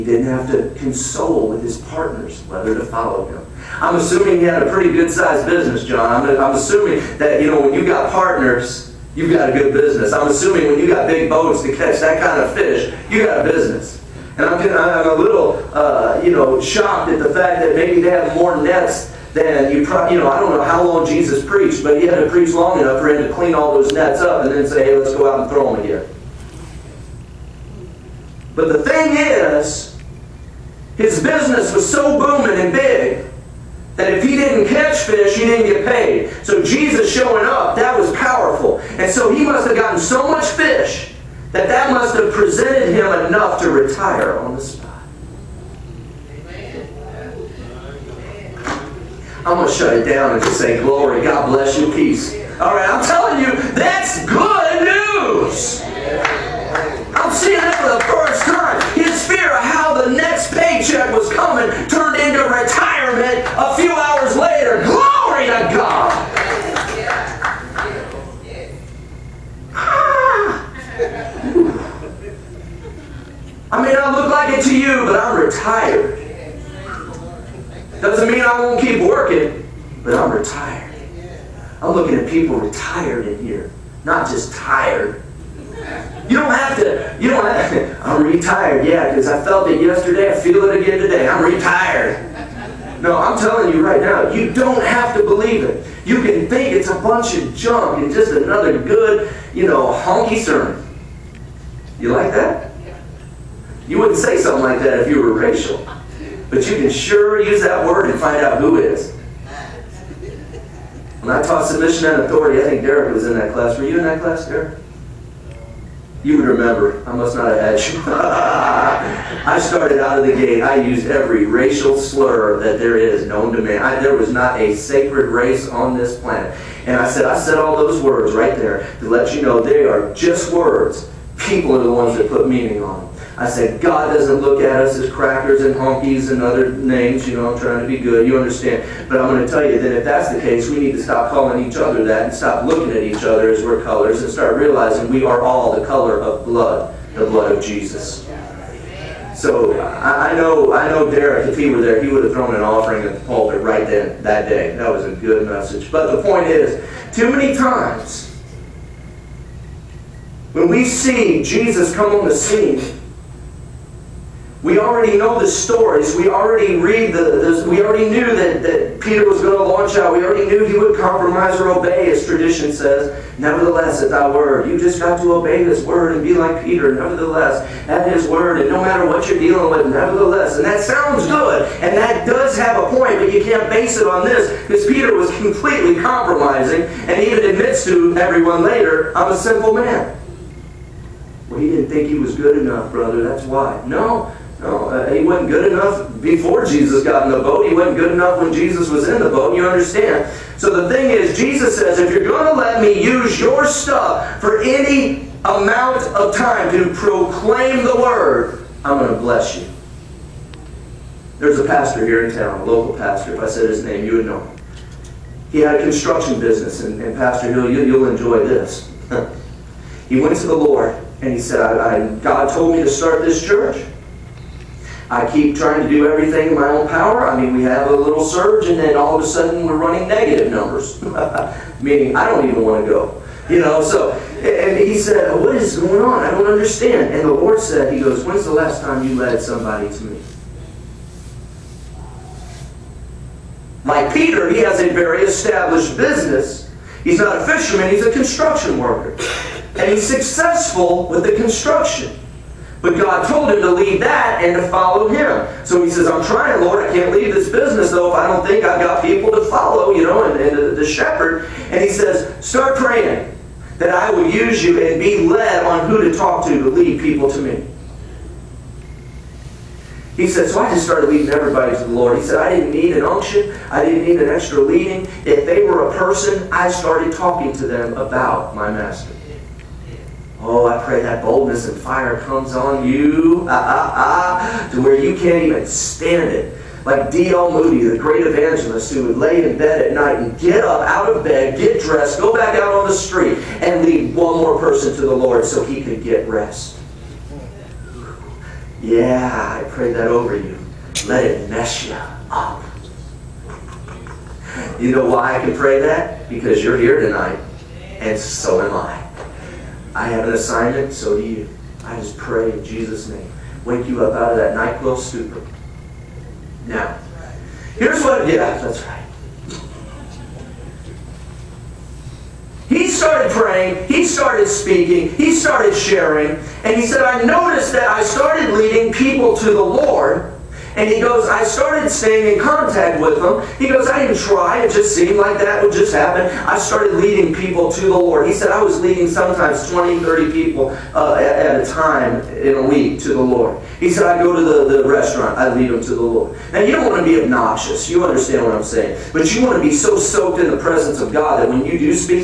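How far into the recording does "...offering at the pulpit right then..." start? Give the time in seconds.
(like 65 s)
152 s.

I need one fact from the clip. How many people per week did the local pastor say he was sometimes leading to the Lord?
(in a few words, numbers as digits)
20 to 30.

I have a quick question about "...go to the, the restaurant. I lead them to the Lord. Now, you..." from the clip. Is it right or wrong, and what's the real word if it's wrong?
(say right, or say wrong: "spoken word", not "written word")
right.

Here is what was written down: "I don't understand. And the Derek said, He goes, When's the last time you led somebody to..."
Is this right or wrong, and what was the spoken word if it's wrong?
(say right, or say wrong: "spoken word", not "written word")
wrong: "Lord", not "Derek".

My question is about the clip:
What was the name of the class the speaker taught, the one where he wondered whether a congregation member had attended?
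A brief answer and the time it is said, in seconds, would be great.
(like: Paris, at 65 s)
submission and authority, at 111 s.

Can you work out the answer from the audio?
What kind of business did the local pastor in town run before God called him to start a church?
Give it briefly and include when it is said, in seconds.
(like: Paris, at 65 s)
construction business, at 215 s.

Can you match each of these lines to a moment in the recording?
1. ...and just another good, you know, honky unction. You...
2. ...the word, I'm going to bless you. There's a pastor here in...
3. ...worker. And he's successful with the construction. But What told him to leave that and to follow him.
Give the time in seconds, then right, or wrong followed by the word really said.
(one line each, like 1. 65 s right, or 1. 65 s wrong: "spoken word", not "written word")
1. 98 s wrong: "sermon", not "unction"
2. 207 s right
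3. 248 s wrong: "God", not "What".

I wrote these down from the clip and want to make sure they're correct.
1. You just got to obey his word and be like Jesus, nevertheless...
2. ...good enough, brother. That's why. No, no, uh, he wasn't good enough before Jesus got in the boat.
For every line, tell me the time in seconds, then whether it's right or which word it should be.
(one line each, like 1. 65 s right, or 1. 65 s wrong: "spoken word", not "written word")
1. 174 s wrong: "Peter", not "Jesus"
2. 192 s right.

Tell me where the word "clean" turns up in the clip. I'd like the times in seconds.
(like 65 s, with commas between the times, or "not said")
23 s.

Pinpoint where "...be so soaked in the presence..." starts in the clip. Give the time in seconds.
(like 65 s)
349 s.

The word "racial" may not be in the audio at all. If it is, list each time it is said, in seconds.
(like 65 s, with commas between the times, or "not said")
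105 s, 121 s.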